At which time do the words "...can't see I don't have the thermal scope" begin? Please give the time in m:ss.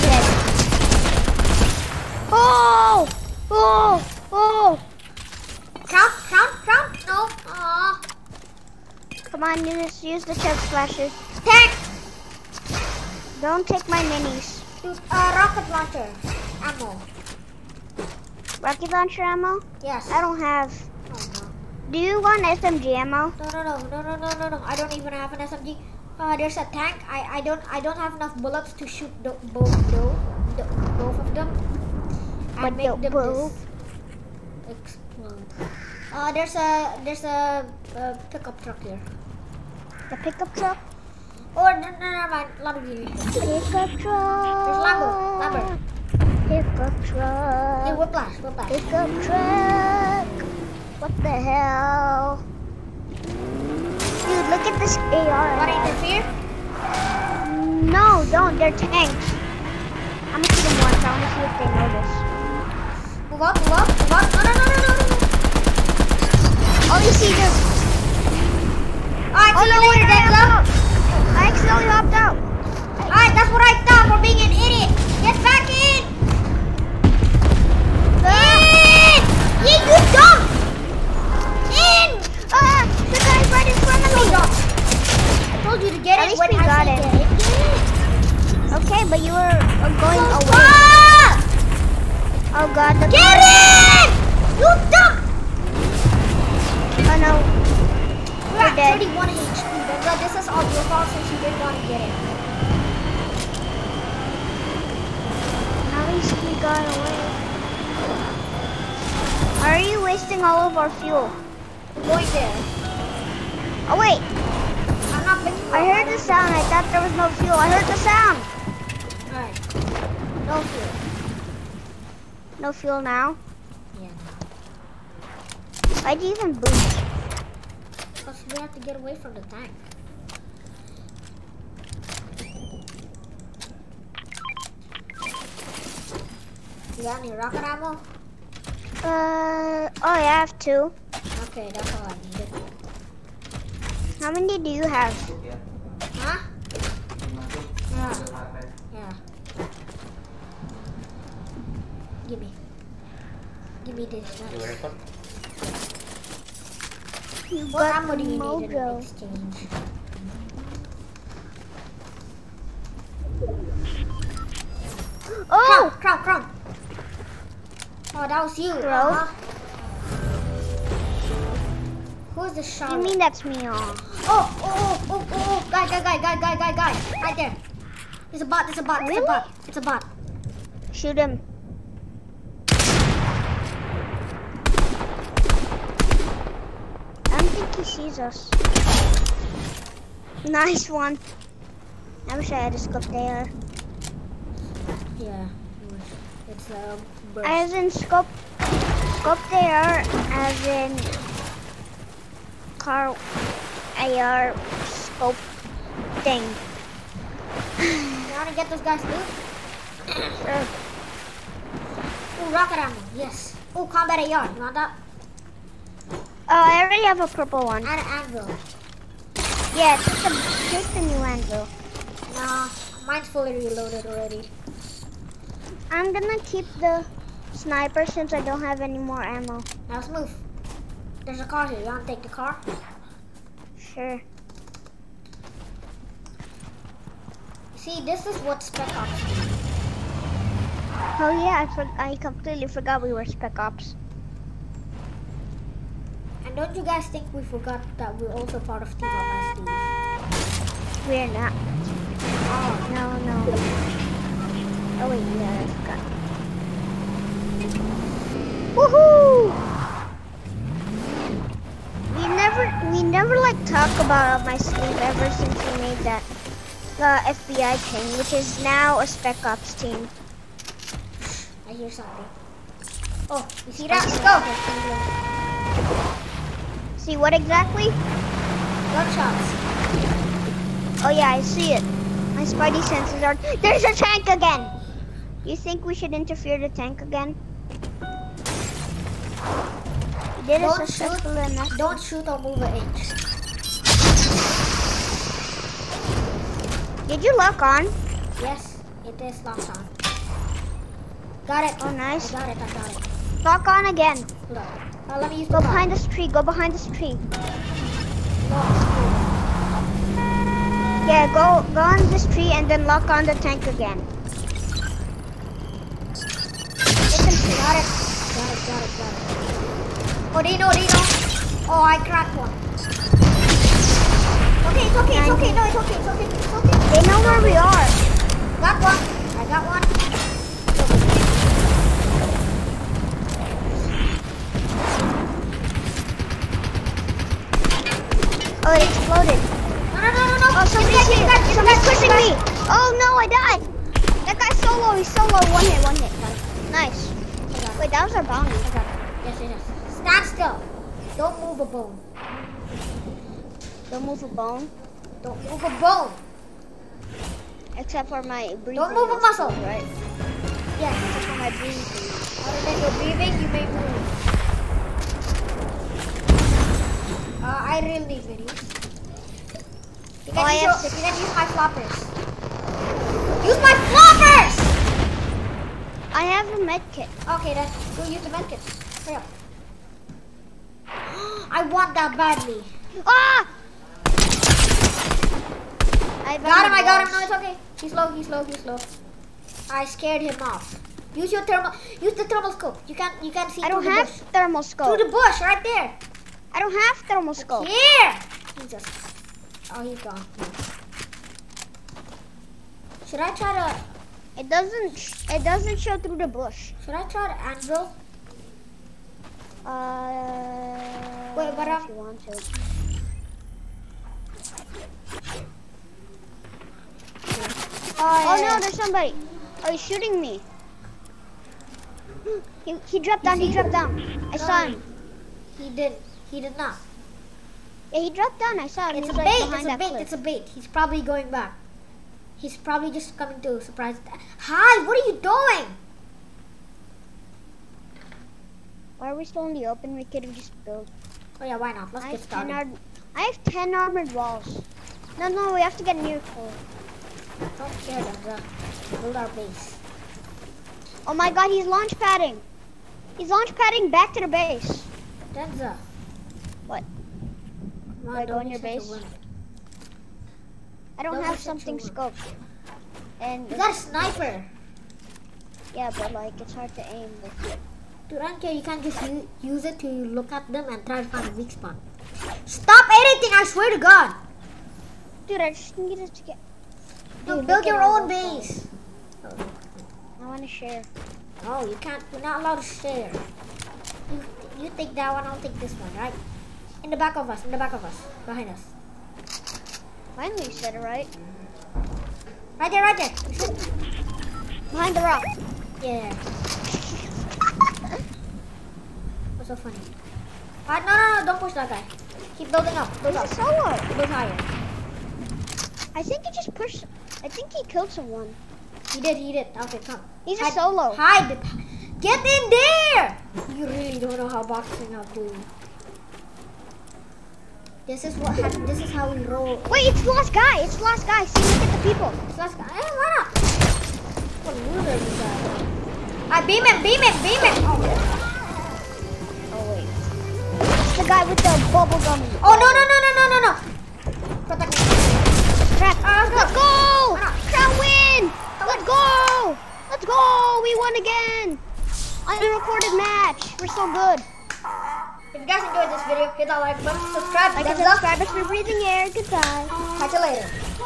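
6:33.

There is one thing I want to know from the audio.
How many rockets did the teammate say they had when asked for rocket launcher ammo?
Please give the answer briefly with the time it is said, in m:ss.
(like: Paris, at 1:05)
2, at 2:20.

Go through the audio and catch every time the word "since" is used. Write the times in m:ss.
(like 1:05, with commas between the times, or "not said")
3:48, 4:25.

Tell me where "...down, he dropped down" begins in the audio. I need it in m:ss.
7:03.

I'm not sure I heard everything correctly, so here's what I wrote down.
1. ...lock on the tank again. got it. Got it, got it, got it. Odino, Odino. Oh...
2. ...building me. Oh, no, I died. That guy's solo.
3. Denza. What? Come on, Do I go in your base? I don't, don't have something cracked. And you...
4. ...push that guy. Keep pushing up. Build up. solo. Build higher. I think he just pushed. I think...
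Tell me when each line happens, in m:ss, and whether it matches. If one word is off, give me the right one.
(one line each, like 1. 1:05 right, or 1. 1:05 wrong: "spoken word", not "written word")
1. 5:12 right
2. 5:41 wrong: "pushing", not "building"
3. 7:35 wrong: "scoped", not "cracked"
4. 8:21 wrong: "building", not "pushing".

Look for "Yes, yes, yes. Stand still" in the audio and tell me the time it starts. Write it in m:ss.
5:49.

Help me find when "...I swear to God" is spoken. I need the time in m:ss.
7:53.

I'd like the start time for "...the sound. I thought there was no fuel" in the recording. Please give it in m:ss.
1:56.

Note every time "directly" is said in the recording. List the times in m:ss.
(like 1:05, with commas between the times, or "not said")
not said.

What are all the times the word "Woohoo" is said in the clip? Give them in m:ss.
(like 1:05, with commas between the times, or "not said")
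4:18.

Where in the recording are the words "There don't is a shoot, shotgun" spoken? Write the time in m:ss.
4:50.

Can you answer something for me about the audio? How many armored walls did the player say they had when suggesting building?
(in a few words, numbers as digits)
10.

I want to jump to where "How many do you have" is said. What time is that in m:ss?
2:24.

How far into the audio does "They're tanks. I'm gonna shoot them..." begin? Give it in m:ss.
0:58.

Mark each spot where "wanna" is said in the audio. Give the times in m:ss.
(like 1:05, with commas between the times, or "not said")
1:01, 3:28.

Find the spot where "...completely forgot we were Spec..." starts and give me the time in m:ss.
4:02.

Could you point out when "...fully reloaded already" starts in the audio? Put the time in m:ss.
3:43.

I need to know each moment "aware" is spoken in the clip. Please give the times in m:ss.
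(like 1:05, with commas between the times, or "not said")
not said.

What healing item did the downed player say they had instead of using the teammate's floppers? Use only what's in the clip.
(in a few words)
Medkit.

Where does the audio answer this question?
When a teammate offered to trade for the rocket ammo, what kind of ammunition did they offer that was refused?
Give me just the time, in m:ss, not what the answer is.
0:22.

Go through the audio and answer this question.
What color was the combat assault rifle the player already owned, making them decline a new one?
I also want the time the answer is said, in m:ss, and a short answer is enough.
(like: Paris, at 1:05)
Purple, at 3:37.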